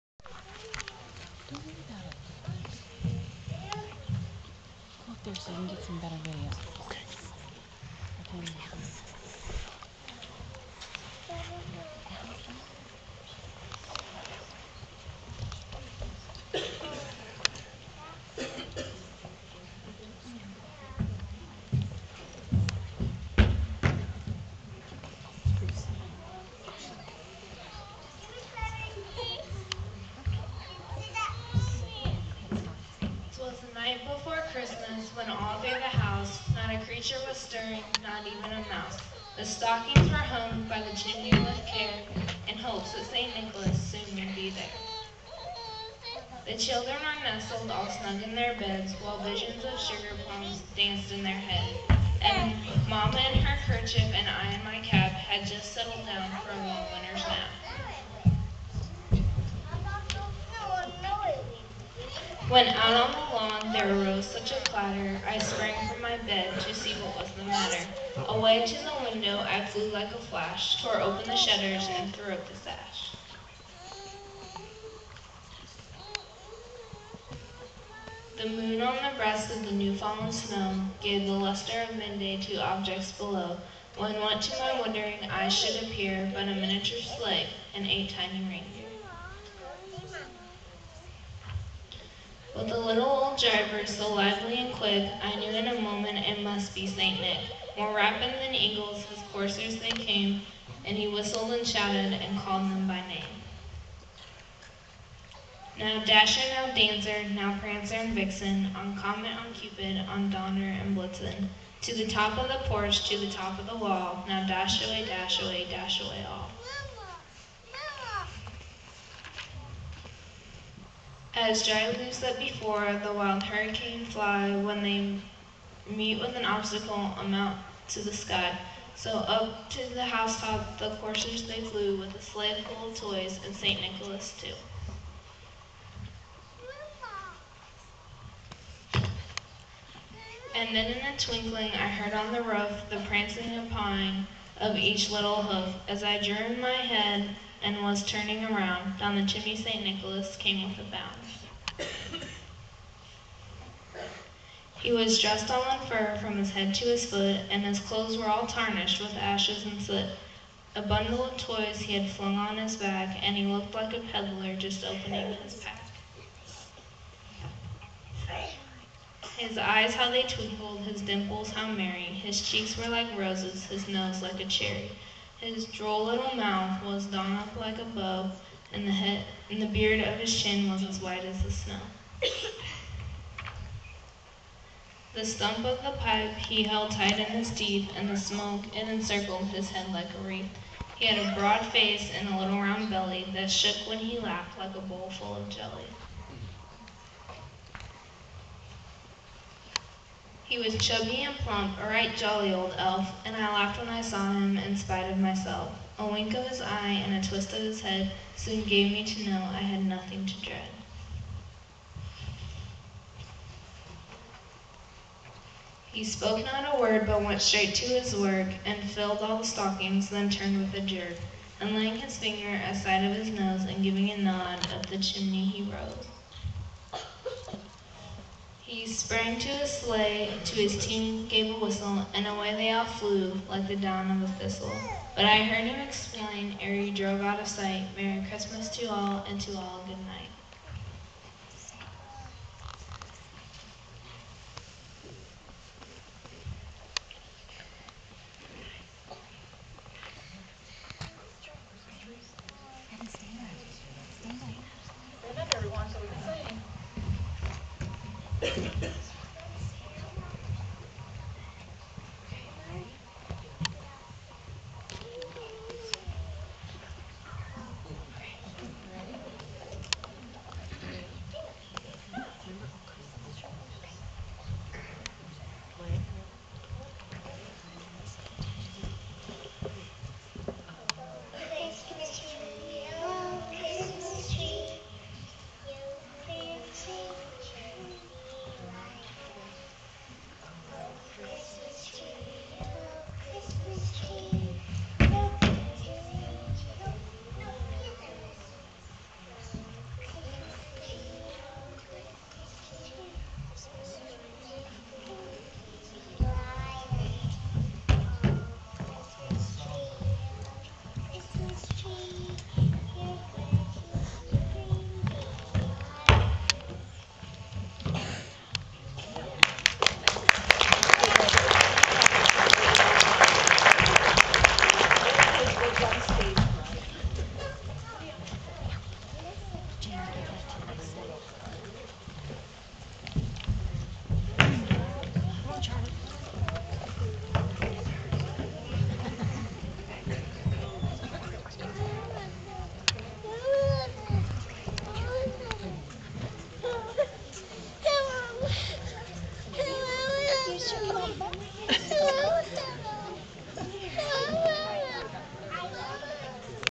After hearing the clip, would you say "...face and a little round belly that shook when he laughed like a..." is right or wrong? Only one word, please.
right.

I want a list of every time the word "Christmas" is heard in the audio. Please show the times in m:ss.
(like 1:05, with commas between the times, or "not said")
0:34, 3:58.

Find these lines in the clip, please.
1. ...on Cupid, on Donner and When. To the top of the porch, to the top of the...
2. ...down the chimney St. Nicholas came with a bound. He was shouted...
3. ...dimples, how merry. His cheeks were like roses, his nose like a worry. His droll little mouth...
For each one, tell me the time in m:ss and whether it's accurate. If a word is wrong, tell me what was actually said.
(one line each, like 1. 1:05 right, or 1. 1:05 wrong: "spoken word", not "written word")
1. 1:49 wrong: "Blitzen", not "When"
2. 2:28 wrong: "dressed", not "shouted"
3. 2:51 wrong: "cherry", not "worry".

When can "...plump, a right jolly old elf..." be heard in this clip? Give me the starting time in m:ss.
3:21.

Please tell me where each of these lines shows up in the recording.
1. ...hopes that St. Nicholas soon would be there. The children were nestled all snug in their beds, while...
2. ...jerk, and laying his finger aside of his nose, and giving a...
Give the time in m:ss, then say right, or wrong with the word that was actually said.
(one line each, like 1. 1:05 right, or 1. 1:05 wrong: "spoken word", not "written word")
1. 0:42 right
2. 3:40 right.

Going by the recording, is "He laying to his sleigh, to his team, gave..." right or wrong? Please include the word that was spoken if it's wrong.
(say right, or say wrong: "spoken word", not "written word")
wrong: "sprang", not "laying".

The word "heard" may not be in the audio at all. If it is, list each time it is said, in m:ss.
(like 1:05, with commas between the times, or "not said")
2:21, 3:55.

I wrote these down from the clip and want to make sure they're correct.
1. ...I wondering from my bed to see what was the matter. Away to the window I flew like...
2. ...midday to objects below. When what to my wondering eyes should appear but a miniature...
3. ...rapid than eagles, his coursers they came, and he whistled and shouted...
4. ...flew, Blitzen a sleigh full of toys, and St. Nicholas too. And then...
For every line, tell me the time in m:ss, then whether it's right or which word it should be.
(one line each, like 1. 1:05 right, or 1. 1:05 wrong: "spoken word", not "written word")
1. 1:05 wrong: "sprang", not "wondering"
2. 1:21 right
3. 1:37 right
4. 2:11 wrong: "With", not "Blitzen".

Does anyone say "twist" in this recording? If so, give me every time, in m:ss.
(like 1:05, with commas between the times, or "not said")
3:27.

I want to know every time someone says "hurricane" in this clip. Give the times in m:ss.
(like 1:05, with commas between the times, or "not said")
2:03.